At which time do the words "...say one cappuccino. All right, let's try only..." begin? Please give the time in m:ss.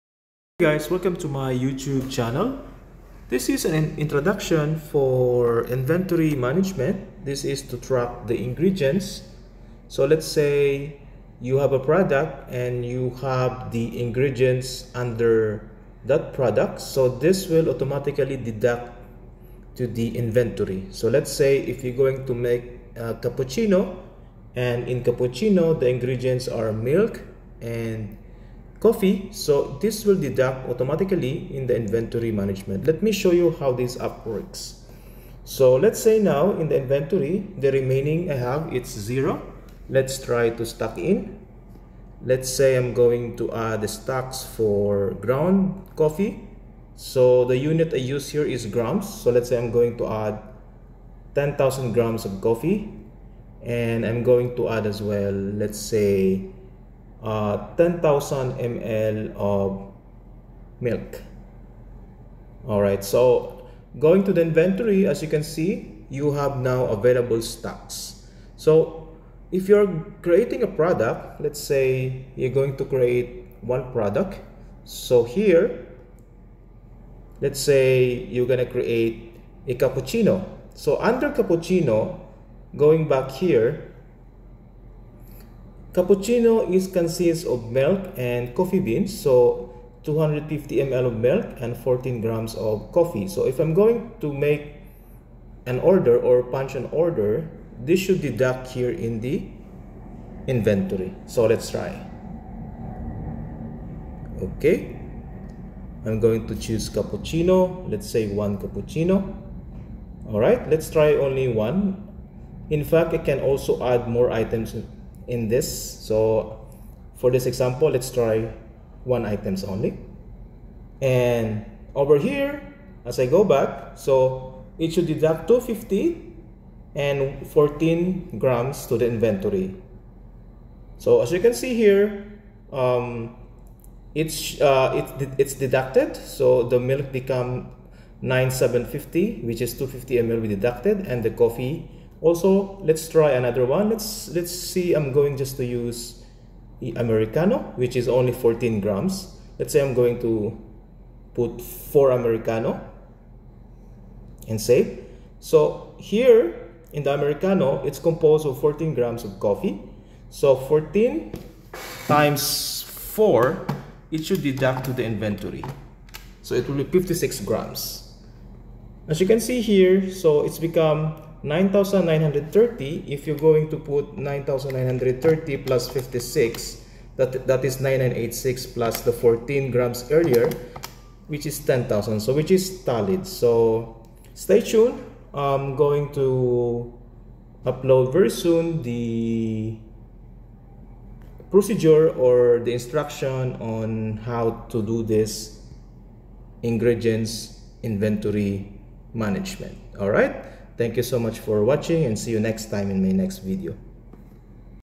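1:48.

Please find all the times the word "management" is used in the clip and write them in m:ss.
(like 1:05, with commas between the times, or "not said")
0:06, 0:32, 3:19.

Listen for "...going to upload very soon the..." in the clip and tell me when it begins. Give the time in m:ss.
3:05.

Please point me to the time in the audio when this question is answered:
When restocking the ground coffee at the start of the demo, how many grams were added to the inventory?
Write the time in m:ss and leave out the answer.
0:51.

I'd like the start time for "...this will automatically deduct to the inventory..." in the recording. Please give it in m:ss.
0:17.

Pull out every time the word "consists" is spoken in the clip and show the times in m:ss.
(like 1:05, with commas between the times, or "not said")
1:26.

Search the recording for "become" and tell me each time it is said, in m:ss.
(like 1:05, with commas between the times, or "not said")
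2:17, 2:50.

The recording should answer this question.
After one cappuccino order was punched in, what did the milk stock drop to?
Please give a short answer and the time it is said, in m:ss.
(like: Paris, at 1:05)
9750, at 2:18.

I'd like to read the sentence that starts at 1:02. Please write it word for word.
All right, so going to the inventory, as you can see, you have now available stocks.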